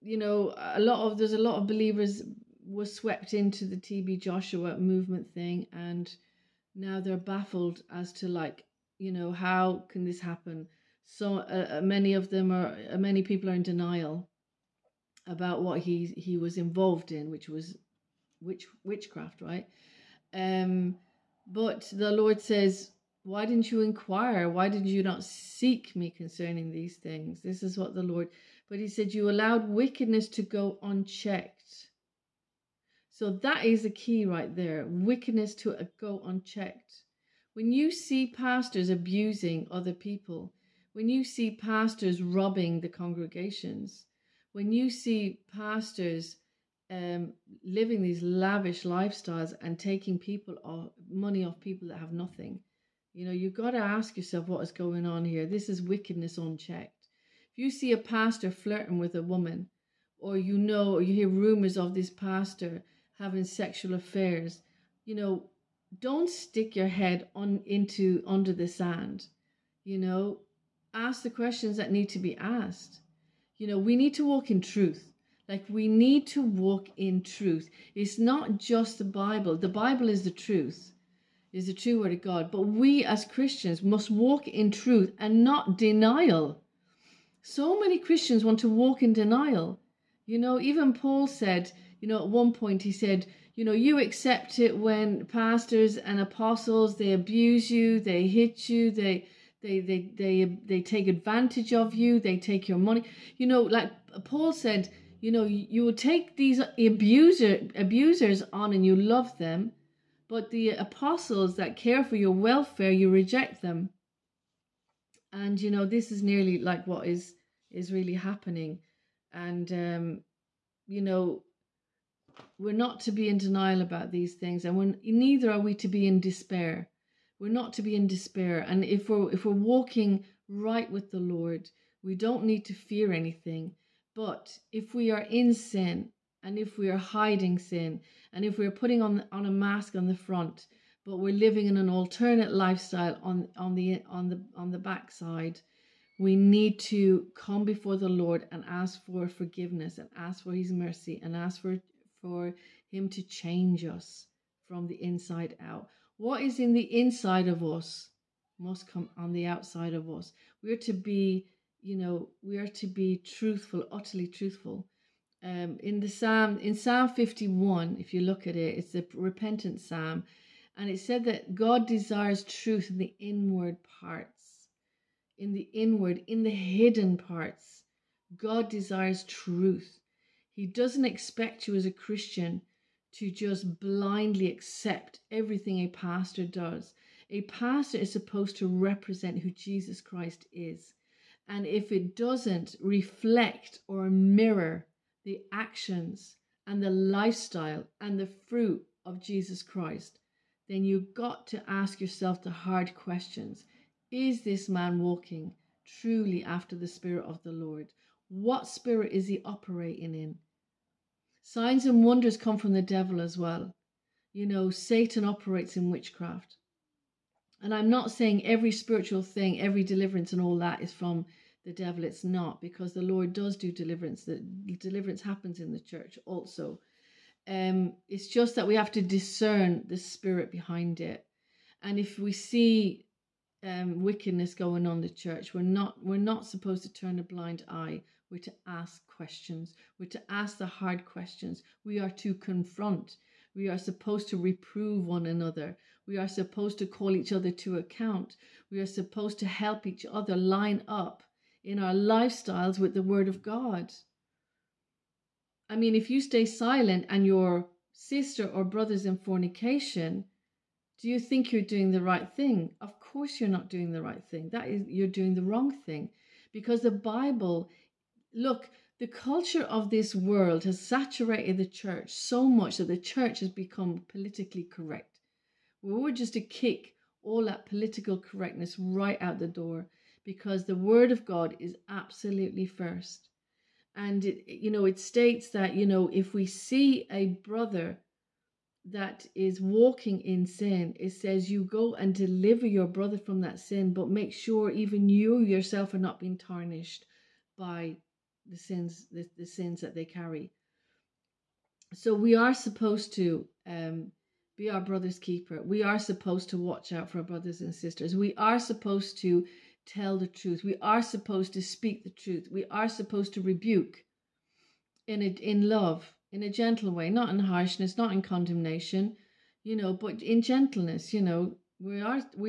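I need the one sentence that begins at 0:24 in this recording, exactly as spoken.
Why did you not seek me concerning these things?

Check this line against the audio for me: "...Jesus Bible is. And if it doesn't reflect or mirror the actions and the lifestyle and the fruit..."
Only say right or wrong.
wrong.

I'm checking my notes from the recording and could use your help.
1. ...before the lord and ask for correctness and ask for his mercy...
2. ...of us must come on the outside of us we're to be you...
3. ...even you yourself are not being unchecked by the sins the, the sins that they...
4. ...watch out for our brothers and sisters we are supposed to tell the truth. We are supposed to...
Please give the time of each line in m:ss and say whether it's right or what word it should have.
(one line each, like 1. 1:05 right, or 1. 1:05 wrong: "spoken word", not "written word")
1. 2:27 wrong: "forgiveness", not "correctness"
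2. 2:37 right
3. 4:54 wrong: "tarnished", not "unchecked"
4. 5:06 right.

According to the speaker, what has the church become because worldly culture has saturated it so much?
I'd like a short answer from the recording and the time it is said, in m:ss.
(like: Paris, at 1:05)
Politically correct, at 4:34.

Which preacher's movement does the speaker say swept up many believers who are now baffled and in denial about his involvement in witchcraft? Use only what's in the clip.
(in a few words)
TB Joshua.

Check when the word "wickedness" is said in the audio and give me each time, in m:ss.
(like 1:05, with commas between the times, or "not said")
0:29, 0:34, 0:55, 3:54.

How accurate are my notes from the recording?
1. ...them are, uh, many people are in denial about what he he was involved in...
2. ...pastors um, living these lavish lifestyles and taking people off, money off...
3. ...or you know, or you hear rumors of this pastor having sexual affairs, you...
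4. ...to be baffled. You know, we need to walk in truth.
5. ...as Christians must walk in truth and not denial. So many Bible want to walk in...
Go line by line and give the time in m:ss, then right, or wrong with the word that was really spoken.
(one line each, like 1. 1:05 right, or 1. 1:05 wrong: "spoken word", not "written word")
1. 0:12 right
2. 0:45 right
3. 1:00 right
4. 1:12 wrong: "asked", not "baffled"
5. 1:23 wrong: "Christians", not "Bible".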